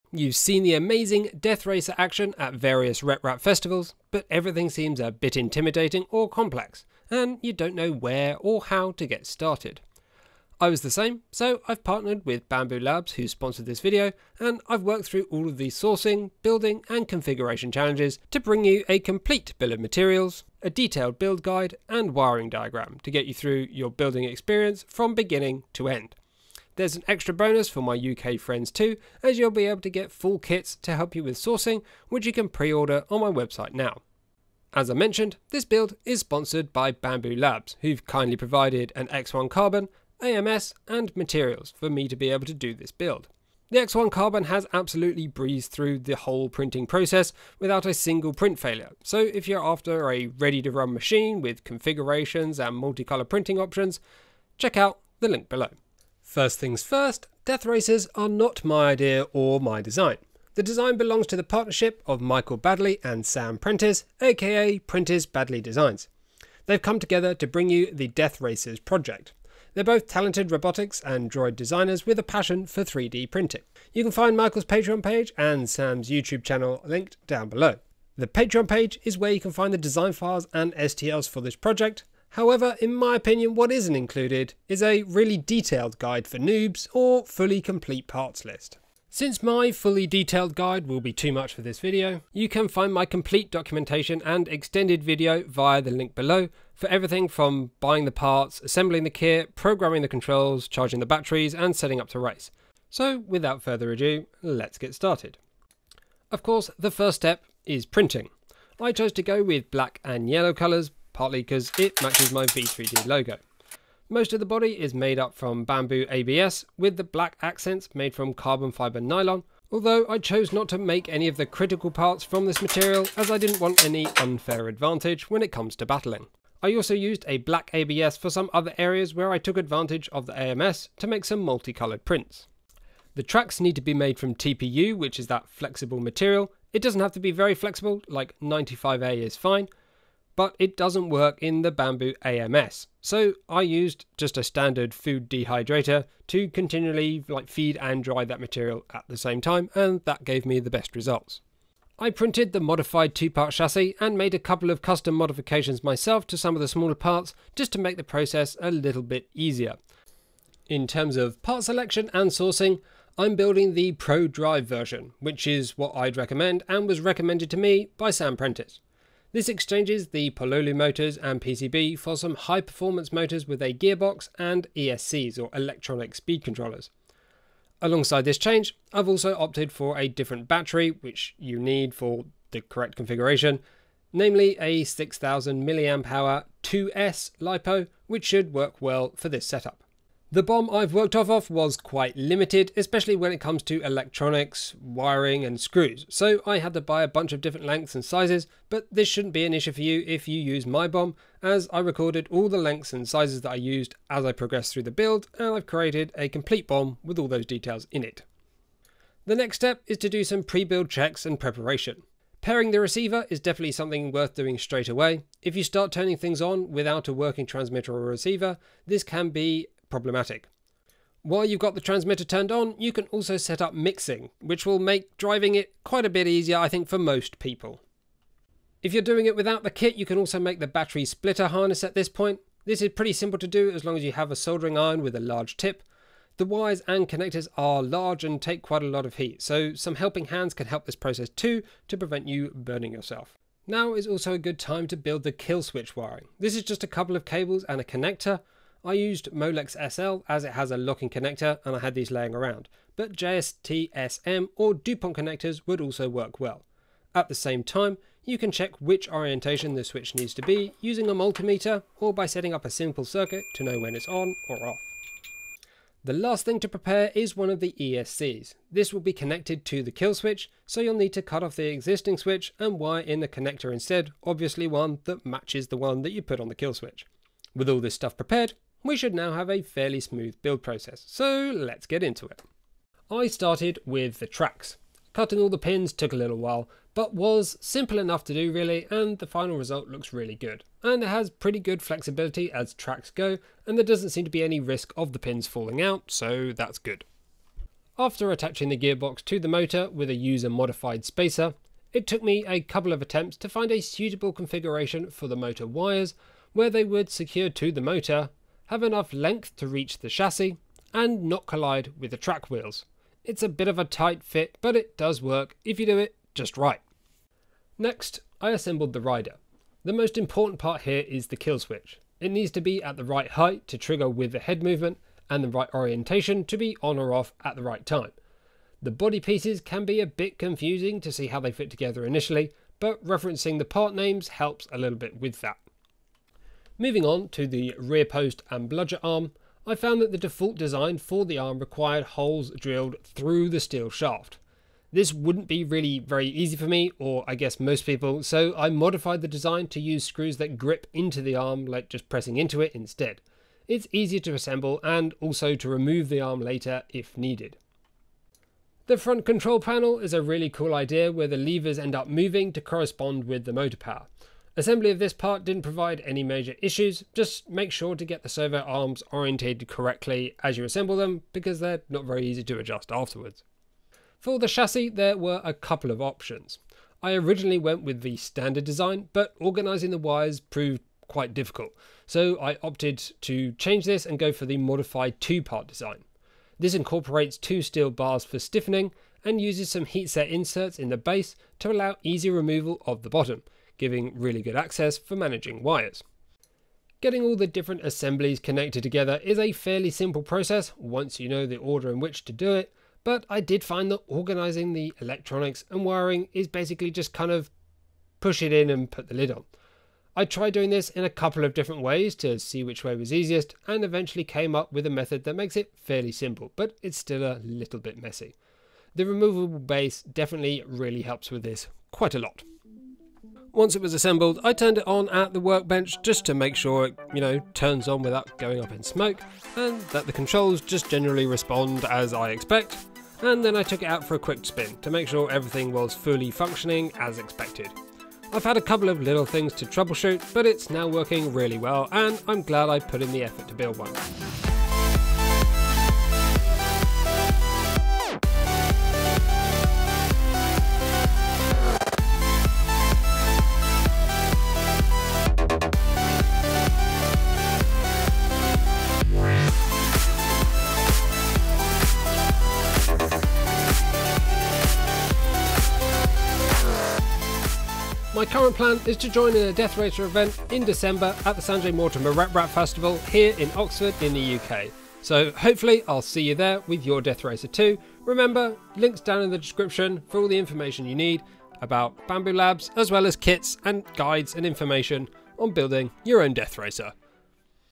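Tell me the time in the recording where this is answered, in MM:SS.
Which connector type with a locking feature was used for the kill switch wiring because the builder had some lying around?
04:09.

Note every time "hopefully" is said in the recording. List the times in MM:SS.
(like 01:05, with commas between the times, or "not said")
07:55.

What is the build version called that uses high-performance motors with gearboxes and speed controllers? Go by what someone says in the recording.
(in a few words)
Pro Drive.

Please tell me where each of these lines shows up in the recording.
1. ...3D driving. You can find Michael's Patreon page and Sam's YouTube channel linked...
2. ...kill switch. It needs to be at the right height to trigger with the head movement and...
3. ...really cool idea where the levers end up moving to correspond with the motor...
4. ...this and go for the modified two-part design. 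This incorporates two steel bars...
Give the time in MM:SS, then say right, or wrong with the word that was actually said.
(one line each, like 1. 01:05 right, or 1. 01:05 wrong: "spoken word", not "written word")
1. 01:12 wrong: "printing", not "driving"
2. 05:21 right
3. 06:00 right
4. 06:23 right.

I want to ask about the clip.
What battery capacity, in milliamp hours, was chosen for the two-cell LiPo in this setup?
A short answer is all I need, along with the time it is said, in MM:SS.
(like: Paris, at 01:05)
6000 mAh, at 03:04.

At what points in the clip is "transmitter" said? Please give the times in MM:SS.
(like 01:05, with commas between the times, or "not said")
03:37, 03:41.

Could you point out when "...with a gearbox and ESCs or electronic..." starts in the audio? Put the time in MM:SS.
02:53.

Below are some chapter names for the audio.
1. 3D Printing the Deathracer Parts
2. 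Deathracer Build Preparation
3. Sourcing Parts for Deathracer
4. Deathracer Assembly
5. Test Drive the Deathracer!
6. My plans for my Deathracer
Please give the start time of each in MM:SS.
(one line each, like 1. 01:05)
1. 01:45
2. 03:28
3. 02:40
4. 04:42
5. 07:03
6. 07:48.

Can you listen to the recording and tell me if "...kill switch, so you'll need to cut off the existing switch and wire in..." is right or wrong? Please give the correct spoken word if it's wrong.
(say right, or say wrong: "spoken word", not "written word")
right.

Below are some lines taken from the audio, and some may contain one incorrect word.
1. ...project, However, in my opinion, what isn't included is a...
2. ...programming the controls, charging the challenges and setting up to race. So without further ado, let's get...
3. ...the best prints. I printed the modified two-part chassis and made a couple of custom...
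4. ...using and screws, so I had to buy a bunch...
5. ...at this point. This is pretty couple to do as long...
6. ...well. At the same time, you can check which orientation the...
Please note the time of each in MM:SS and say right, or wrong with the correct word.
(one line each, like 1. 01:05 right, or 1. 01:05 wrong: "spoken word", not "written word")
1. 01:21 right
2. 01:39 wrong: "batteries", not "challenges"
3. 02:30 wrong: "results", not "prints"
4. 03:14 wrong: "wiring", not "using"
5. 03:51 wrong: "simple", not "couple"
6. 04:16 right.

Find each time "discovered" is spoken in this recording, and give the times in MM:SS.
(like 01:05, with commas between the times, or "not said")
not said.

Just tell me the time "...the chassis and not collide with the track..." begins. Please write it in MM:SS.
05:09.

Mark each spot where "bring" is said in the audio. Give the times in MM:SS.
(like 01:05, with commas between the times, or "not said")
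00:18, 01:07.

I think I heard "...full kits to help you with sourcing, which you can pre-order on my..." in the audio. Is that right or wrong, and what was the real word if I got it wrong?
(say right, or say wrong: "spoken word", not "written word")
right.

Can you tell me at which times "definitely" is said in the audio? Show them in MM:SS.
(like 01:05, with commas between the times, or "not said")
03:33, 07:00.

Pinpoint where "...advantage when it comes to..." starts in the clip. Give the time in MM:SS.
02:04.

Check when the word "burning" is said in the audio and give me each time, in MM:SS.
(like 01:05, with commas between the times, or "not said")
04:02.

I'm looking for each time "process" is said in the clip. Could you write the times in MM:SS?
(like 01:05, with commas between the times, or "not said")
00:46, 02:38, 04:00, 04:40, 06:40.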